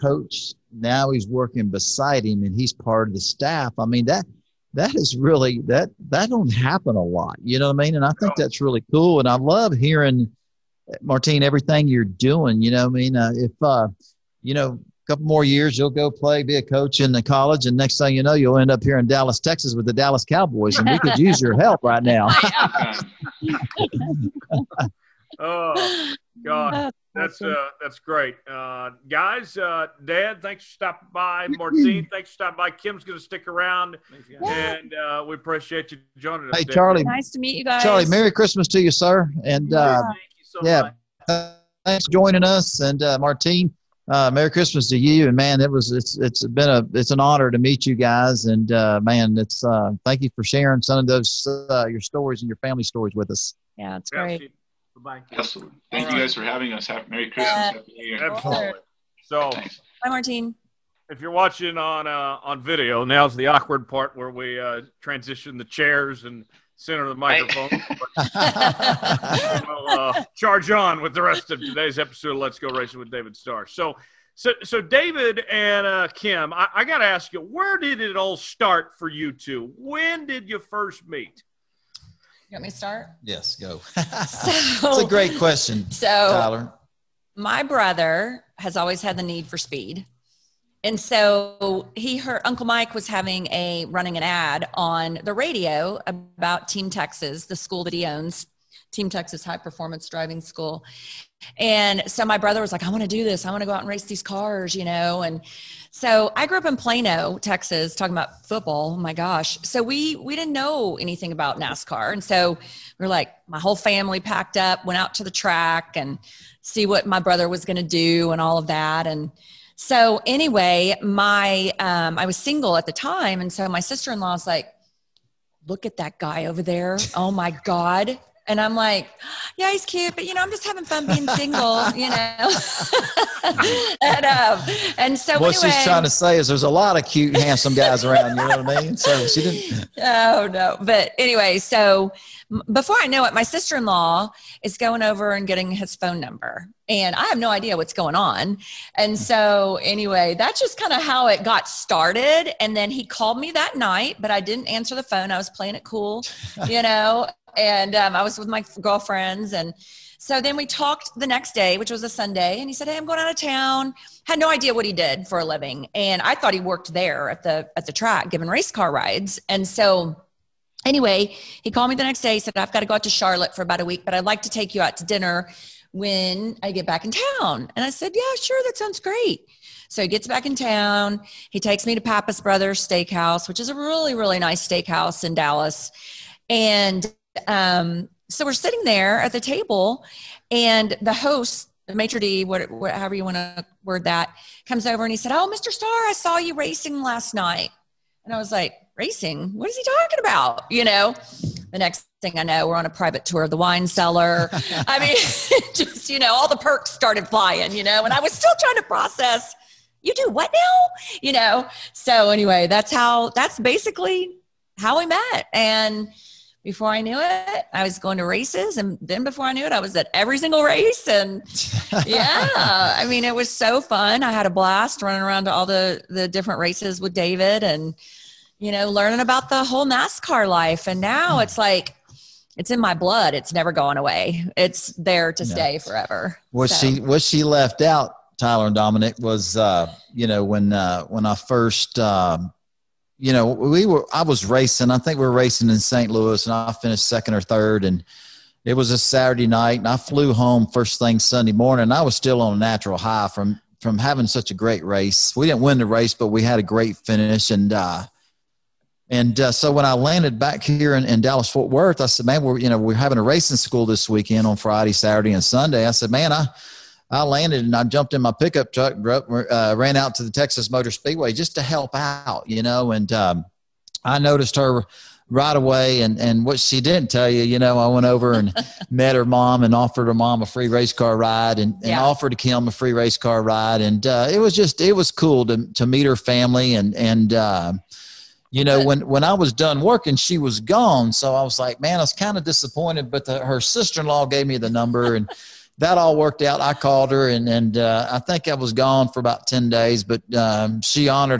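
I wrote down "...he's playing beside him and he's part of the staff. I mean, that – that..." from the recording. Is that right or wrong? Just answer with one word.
wrong.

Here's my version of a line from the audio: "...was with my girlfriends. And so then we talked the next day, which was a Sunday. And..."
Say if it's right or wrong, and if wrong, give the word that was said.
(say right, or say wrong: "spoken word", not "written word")
right.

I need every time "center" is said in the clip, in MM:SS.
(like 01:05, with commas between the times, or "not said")
01:06.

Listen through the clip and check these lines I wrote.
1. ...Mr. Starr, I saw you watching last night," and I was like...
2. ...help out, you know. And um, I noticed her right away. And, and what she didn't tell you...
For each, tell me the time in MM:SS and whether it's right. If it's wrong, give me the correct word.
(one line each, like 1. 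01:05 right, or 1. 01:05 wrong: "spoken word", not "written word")
1. 03:15 wrong: "racing", not "watching"
2. 04:31 right.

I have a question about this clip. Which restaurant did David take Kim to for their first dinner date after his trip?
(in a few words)
Pappas Brothers Steakhouse.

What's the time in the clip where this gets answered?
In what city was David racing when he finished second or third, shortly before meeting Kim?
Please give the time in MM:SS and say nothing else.
04:05.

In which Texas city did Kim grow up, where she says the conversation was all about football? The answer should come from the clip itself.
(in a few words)
Plano.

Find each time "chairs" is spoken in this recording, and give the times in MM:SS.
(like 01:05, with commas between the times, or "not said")
01:05.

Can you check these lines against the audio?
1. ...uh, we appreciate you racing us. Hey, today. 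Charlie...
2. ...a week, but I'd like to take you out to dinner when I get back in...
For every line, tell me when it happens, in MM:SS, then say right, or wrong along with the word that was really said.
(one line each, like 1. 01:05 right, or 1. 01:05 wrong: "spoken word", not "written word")
1. 00:34 wrong: "joining", not "racing"
2. 02:53 right.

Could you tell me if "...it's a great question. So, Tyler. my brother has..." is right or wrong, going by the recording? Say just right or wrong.
right.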